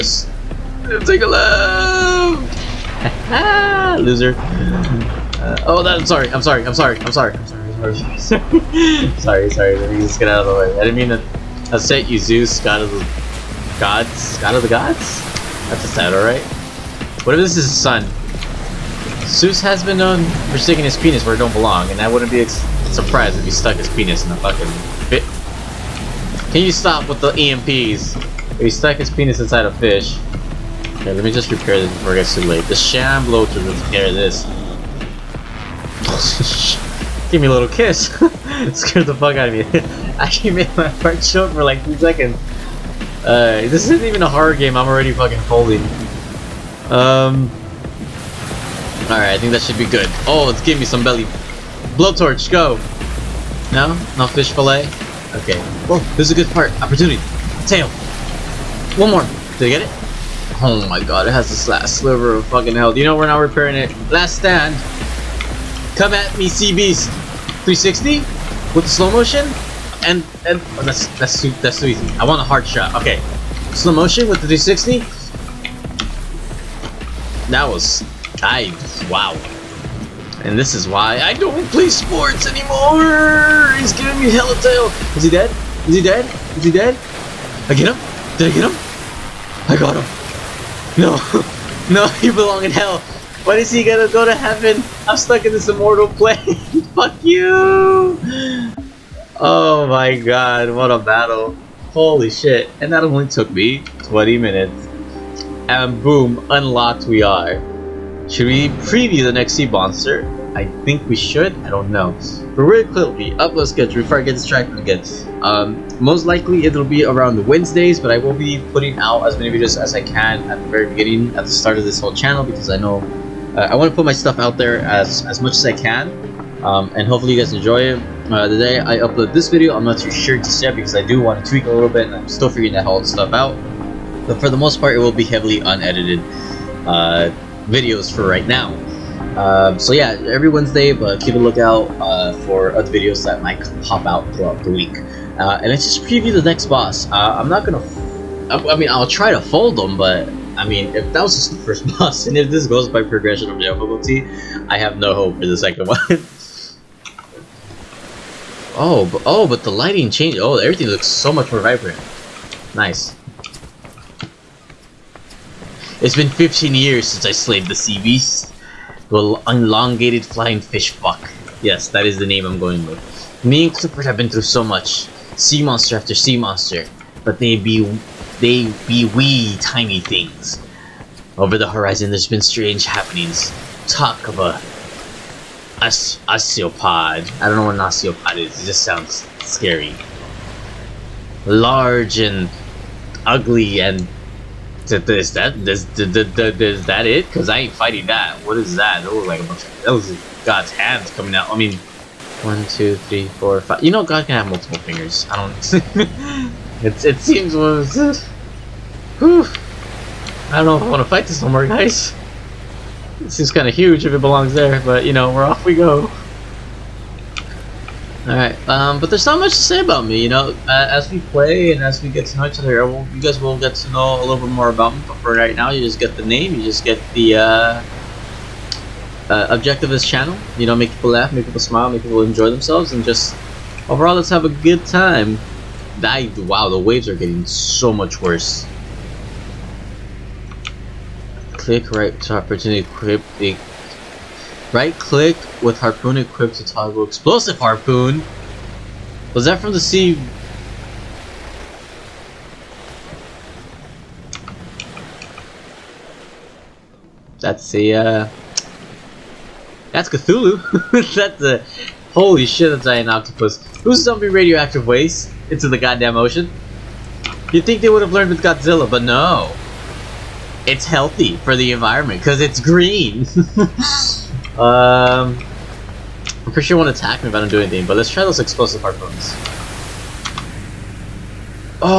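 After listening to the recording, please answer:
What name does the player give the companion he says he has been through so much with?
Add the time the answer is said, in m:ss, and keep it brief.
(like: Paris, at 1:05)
Clifford, at 2:53.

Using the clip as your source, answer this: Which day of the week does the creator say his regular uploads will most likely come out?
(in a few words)
Wednesday.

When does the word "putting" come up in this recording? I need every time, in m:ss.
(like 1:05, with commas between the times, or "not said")
1:58.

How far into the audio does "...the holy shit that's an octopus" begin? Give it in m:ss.
4:21.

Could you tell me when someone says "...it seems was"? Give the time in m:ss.
3:27.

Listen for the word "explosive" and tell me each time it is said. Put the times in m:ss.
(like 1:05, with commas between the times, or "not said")
4:07, 4:38.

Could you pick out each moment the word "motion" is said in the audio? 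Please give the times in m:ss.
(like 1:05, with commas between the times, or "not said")
1:09, 1:13.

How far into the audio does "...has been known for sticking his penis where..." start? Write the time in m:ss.
0:19.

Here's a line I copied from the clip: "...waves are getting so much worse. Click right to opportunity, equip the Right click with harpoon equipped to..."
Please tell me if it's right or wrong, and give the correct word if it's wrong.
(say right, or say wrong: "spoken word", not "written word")
right.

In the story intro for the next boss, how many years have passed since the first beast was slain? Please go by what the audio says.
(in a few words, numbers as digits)
15 years.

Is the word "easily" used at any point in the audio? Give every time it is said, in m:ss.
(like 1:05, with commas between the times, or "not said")
not said.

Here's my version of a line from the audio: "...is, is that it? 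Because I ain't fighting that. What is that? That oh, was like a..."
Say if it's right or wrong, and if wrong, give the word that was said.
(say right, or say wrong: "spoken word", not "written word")
right.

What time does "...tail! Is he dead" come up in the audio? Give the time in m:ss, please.
1:24.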